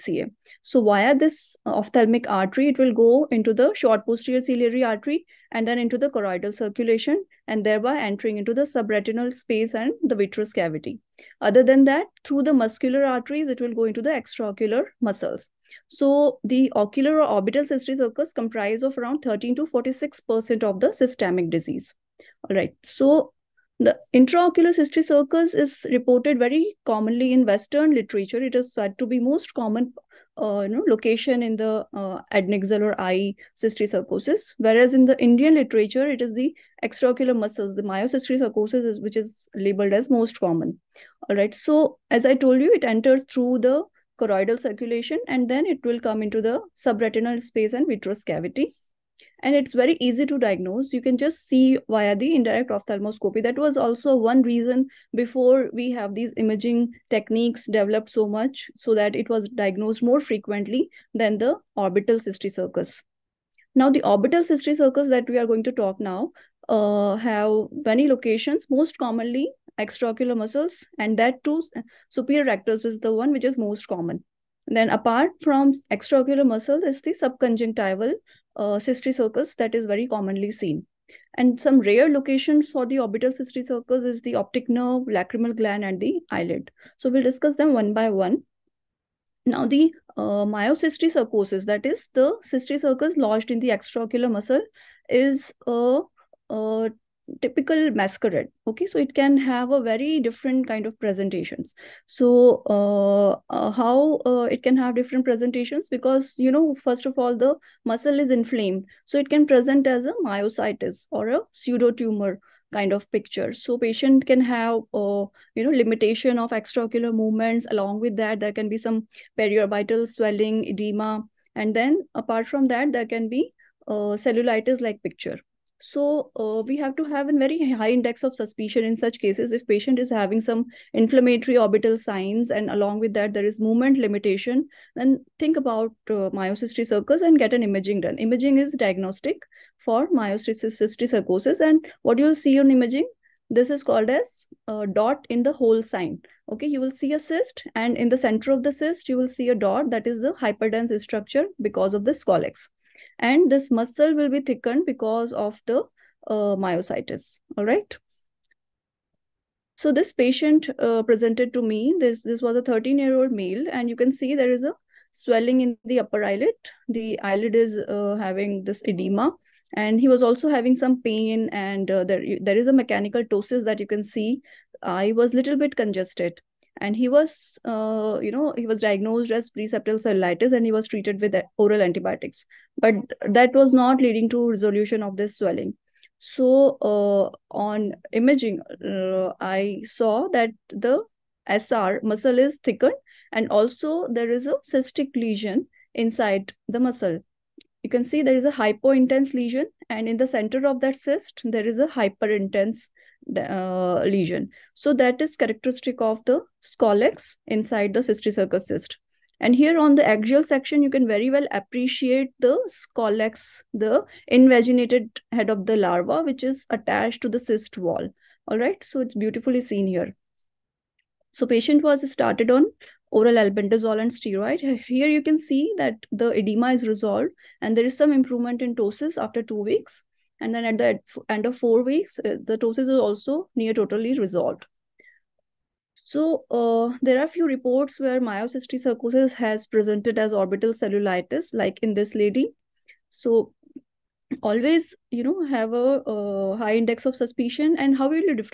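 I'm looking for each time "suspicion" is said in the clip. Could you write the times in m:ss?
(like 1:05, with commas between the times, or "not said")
2:08, 4:07.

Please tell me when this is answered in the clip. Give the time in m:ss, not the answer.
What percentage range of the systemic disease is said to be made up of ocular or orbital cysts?
0:19.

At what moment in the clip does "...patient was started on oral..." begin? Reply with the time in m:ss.
3:41.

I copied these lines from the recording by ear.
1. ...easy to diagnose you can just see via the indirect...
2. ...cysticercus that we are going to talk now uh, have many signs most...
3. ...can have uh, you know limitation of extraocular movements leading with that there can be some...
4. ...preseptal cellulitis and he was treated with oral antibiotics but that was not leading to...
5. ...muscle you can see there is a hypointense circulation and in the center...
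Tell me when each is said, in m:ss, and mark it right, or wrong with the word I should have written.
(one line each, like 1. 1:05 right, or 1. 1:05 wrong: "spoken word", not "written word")
1. 0:49 right
2. 1:04 wrong: "locations", not "signs"
3. 1:54 wrong: "along", not "leading"
4. 2:59 right
5. 3:16 wrong: "lesion", not "circulation".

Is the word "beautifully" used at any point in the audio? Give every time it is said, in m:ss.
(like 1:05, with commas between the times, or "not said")
3:39.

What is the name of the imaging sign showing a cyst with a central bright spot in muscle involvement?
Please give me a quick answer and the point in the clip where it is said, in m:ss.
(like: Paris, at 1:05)
Dot in the hole sign, at 2:24.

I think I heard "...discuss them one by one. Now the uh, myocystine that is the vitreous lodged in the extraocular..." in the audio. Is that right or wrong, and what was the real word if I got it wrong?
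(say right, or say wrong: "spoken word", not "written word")
wrong: "cysticercus", not "vitreous".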